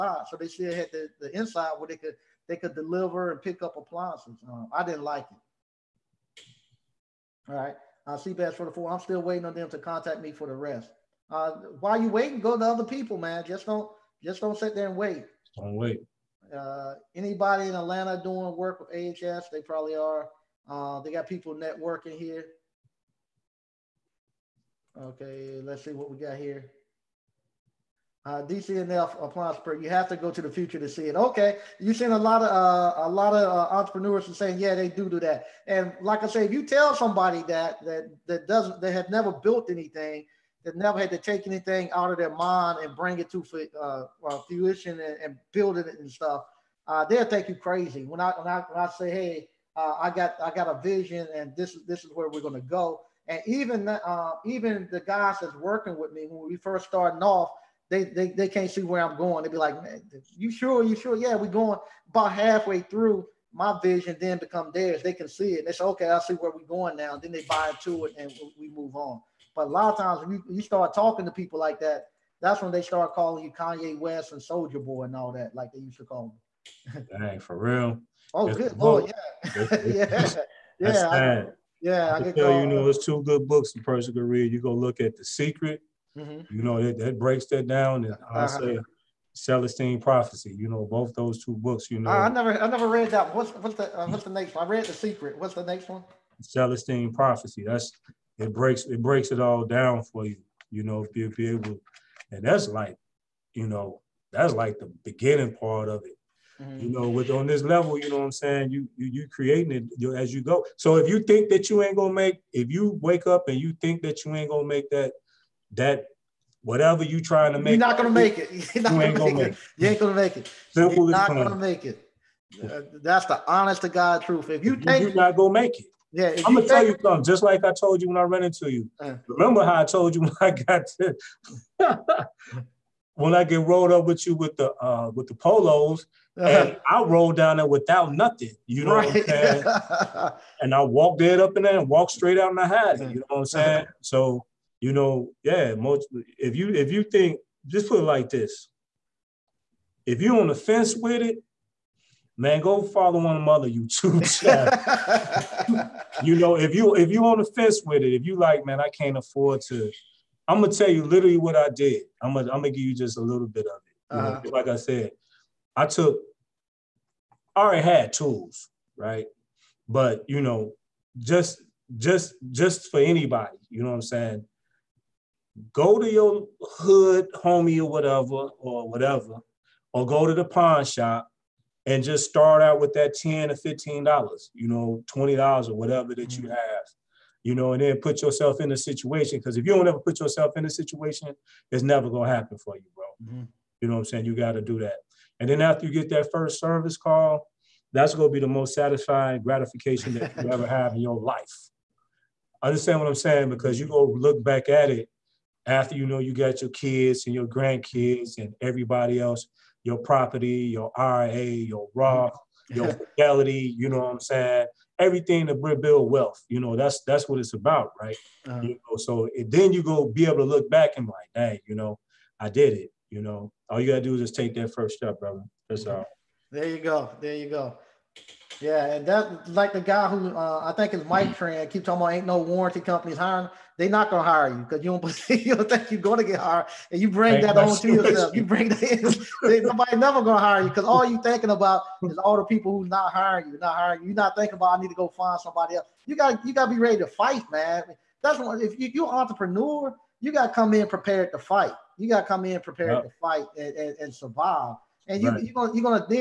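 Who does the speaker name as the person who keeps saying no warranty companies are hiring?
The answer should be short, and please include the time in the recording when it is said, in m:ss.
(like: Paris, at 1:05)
Mike Tran, at 3:51.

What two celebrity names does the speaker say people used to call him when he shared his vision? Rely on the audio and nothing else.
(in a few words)
Kanye West and Soulja Boy.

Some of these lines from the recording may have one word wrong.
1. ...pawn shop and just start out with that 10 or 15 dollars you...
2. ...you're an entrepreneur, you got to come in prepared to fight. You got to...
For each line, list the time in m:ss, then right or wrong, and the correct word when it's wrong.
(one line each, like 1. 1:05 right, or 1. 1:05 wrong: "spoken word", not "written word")
1. 3:00 right
2. 4:08 right.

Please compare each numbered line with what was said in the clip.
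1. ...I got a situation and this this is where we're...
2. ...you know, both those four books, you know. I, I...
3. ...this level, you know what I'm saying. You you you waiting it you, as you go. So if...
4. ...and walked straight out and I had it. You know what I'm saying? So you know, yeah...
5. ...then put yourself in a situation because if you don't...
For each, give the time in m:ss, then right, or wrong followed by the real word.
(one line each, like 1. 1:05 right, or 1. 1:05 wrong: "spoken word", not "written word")
1. 0:50 wrong: "vision", not "situation"
2. 1:30 wrong: "two", not "four"
3. 1:47 wrong: "creating", not "waiting"
4. 2:21 right
5. 3:07 right.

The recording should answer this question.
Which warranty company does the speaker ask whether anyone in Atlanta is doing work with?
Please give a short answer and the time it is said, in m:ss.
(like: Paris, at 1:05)
AHS, at 0:18.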